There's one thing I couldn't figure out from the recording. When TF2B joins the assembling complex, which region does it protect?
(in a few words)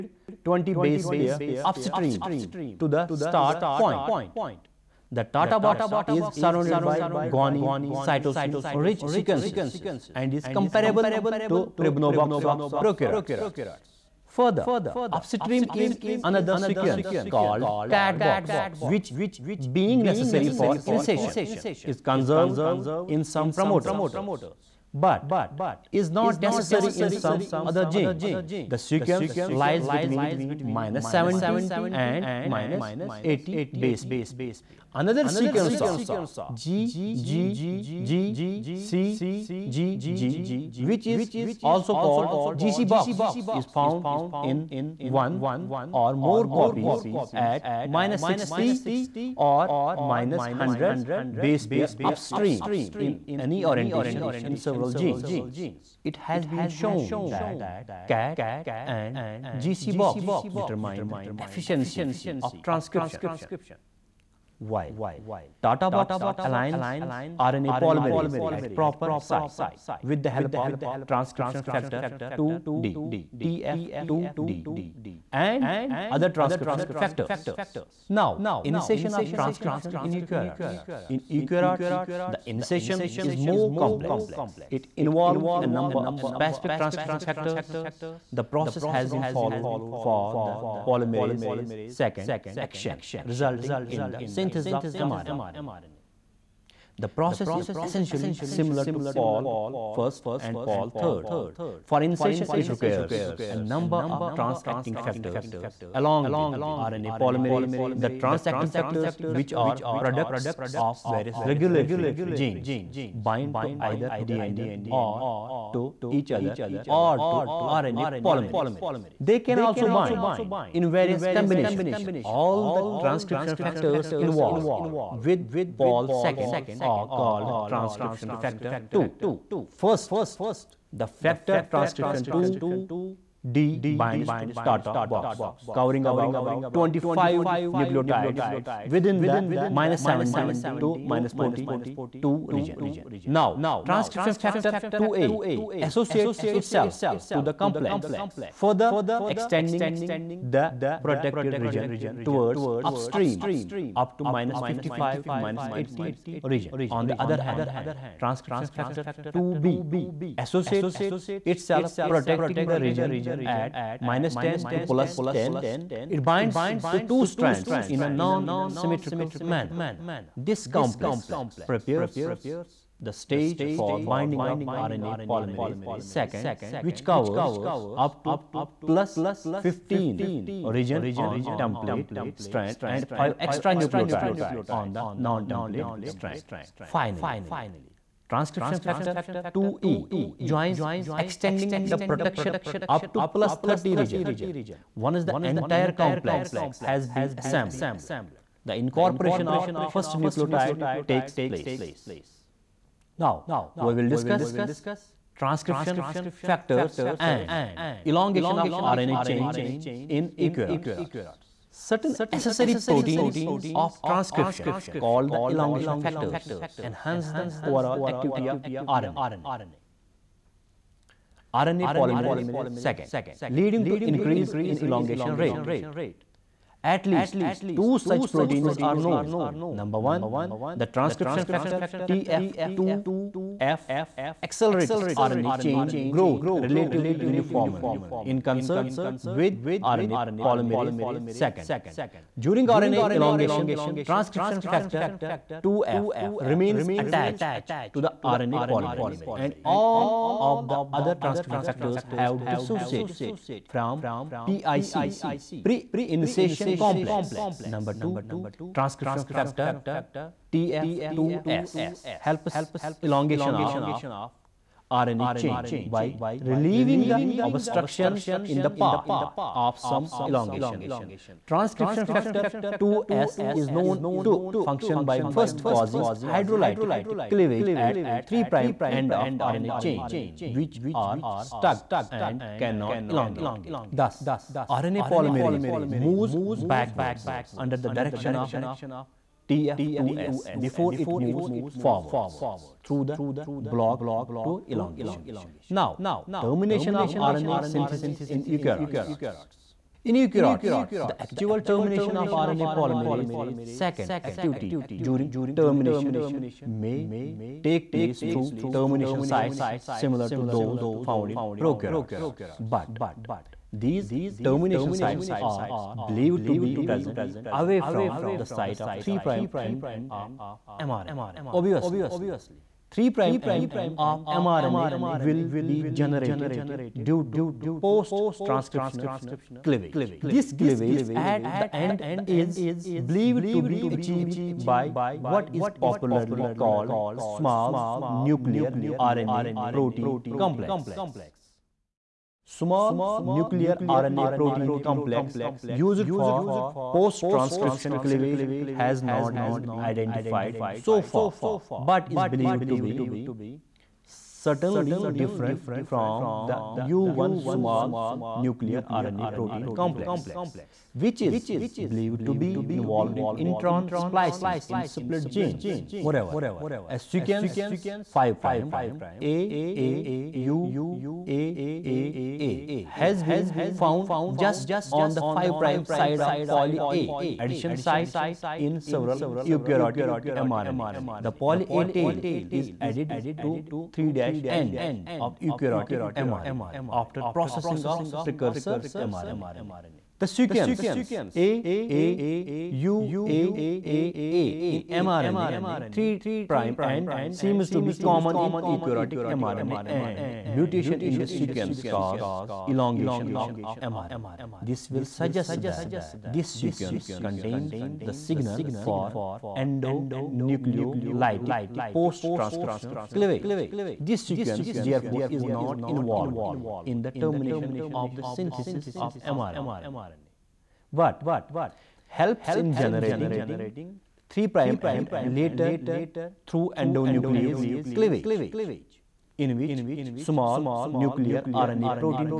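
-10 to +10.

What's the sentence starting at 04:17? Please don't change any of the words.
Number 2, transcription factor TF2S helps elongation of RNA chain by relieving the obstructions in the path of some elongation.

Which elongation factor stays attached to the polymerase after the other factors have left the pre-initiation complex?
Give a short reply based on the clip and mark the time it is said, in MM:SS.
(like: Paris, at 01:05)
TF2F, at 04:04.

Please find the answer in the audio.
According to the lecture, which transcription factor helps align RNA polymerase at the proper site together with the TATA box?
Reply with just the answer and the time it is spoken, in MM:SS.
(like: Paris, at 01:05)
TF2D, at 01:11.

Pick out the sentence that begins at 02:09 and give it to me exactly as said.
First, the factor transcription 2 D binds to Tata box covering about 25 nucleotides within the minus 17 to minus 42 region.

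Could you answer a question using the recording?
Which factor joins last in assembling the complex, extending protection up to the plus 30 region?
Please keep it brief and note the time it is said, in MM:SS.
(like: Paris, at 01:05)
TF2E, at 03:08.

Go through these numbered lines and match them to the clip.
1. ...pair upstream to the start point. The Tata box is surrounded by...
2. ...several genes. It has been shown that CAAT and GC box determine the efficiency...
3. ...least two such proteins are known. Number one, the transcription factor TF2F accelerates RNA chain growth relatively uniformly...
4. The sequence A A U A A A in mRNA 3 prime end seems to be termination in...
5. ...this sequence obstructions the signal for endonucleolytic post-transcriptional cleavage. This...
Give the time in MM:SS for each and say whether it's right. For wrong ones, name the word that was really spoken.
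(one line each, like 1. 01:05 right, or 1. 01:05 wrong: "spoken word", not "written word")
1. 00:01 right
2. 00:54 right
3. 03:47 right
4. 06:30 wrong: "common", not "termination"
5. 06:46 wrong: "contains", not "obstructions".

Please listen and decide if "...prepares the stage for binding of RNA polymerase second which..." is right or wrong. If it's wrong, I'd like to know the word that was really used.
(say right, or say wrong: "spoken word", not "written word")
right.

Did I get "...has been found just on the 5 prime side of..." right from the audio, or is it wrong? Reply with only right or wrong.
right.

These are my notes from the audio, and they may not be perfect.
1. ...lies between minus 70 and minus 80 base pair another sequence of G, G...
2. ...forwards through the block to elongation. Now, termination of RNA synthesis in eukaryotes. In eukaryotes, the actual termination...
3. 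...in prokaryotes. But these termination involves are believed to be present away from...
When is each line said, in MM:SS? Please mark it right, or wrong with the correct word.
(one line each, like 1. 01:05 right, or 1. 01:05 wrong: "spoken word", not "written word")
1. 00:29 right
2. 04:51 right
3. 05:11 wrong: "sites", not "involves".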